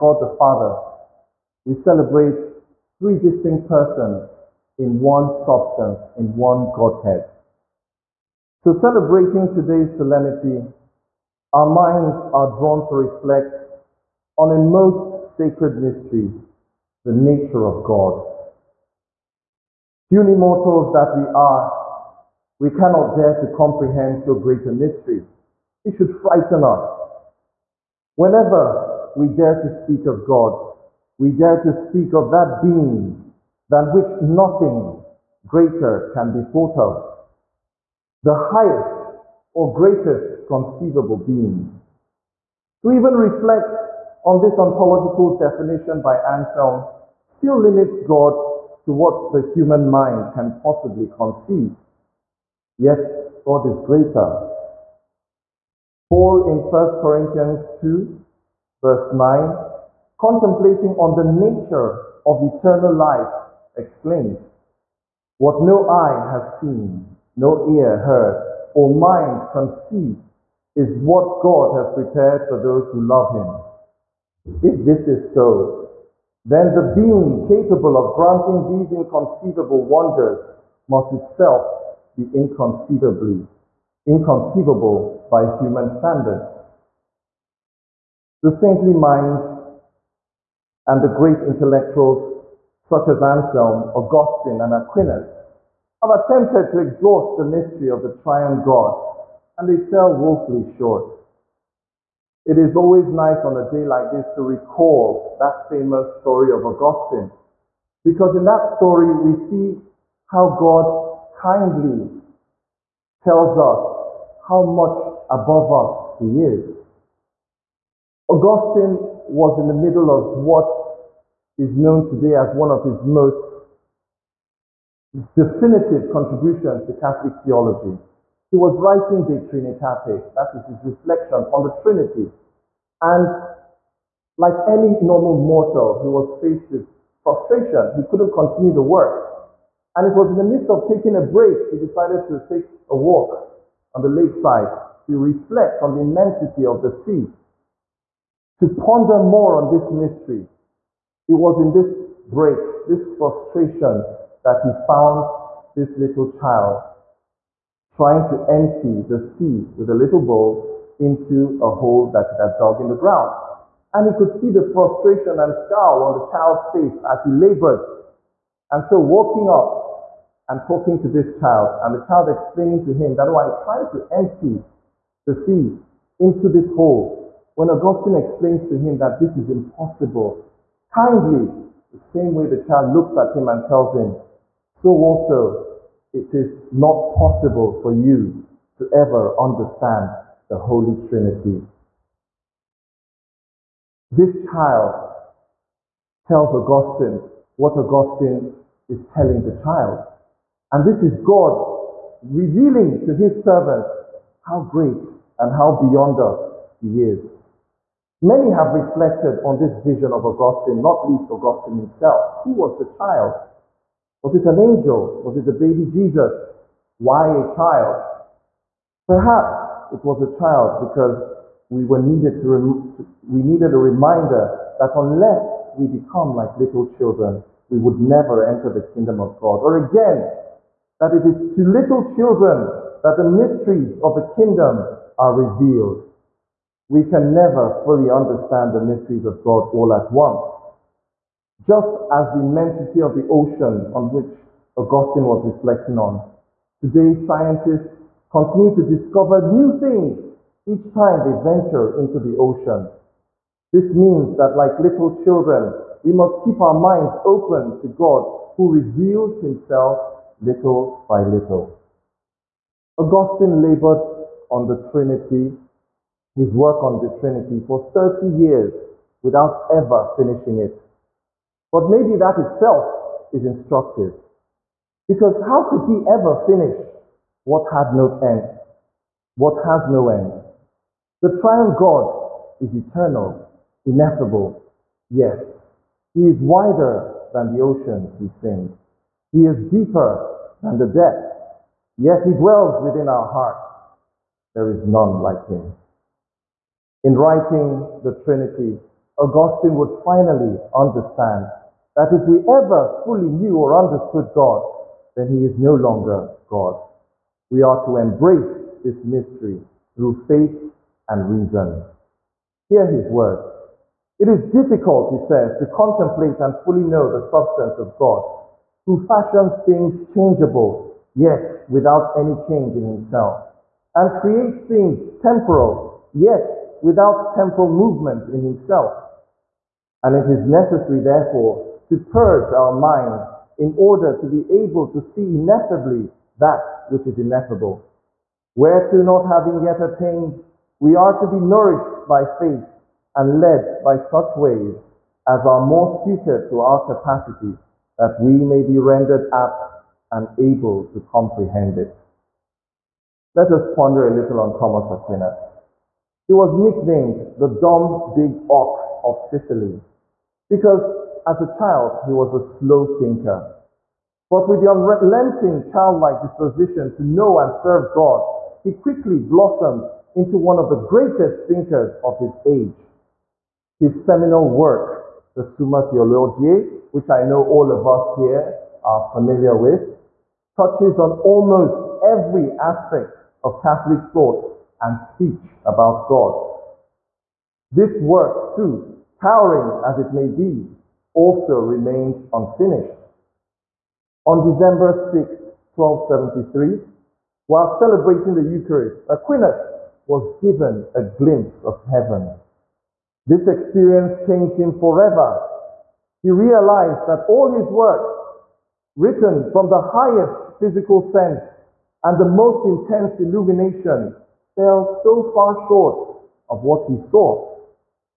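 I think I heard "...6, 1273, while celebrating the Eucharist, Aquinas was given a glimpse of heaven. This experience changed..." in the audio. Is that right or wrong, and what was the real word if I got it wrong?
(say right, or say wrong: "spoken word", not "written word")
right.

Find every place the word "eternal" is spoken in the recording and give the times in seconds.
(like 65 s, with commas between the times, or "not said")
62 s, 282 s.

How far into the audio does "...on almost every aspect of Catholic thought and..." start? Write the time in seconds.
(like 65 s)
380 s.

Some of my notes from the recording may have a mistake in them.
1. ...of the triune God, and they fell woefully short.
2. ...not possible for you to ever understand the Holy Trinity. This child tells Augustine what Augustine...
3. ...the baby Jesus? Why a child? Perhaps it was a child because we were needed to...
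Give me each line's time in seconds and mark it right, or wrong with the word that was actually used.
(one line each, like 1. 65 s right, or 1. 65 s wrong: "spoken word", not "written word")
1. 97 s right
2. 186 s right
3. 215 s right.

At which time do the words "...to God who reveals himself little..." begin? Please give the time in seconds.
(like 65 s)
257 s.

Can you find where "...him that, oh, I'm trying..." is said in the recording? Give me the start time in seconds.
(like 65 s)
172 s.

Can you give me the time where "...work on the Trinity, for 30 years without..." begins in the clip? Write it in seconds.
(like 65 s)
266 s.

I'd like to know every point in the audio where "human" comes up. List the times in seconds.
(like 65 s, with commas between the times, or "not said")
49 s, 85 s.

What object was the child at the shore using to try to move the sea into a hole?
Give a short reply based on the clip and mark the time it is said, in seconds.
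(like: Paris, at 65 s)
A little bowl, at 159 s.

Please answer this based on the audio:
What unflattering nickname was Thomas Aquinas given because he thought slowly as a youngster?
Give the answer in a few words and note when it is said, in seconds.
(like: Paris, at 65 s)
The dumb big ox of Sicily, at 357 s.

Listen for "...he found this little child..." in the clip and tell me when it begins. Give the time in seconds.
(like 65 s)
154 s.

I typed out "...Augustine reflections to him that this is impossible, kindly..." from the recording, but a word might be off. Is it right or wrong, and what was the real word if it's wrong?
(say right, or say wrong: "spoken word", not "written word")
wrong: "explains", not "reflections".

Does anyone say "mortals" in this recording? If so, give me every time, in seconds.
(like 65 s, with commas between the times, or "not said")
20 s, 135 s.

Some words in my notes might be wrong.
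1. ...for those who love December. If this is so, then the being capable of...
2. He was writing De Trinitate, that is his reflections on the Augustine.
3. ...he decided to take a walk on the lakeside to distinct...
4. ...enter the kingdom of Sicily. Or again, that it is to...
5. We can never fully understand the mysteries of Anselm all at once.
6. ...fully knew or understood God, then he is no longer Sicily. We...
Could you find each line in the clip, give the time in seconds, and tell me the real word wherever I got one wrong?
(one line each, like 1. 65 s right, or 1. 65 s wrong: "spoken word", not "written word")
1. 72 s wrong: "Him", not "December"
2. 128 s wrong: "Trinity", not "Augustine"
3. 141 s wrong: "reflect", not "distinct"
4. 228 s wrong: "God", not "Sicily"
5. 236 s wrong: "God", not "Anselm"
6. 303 s wrong: "God", not "Sicily".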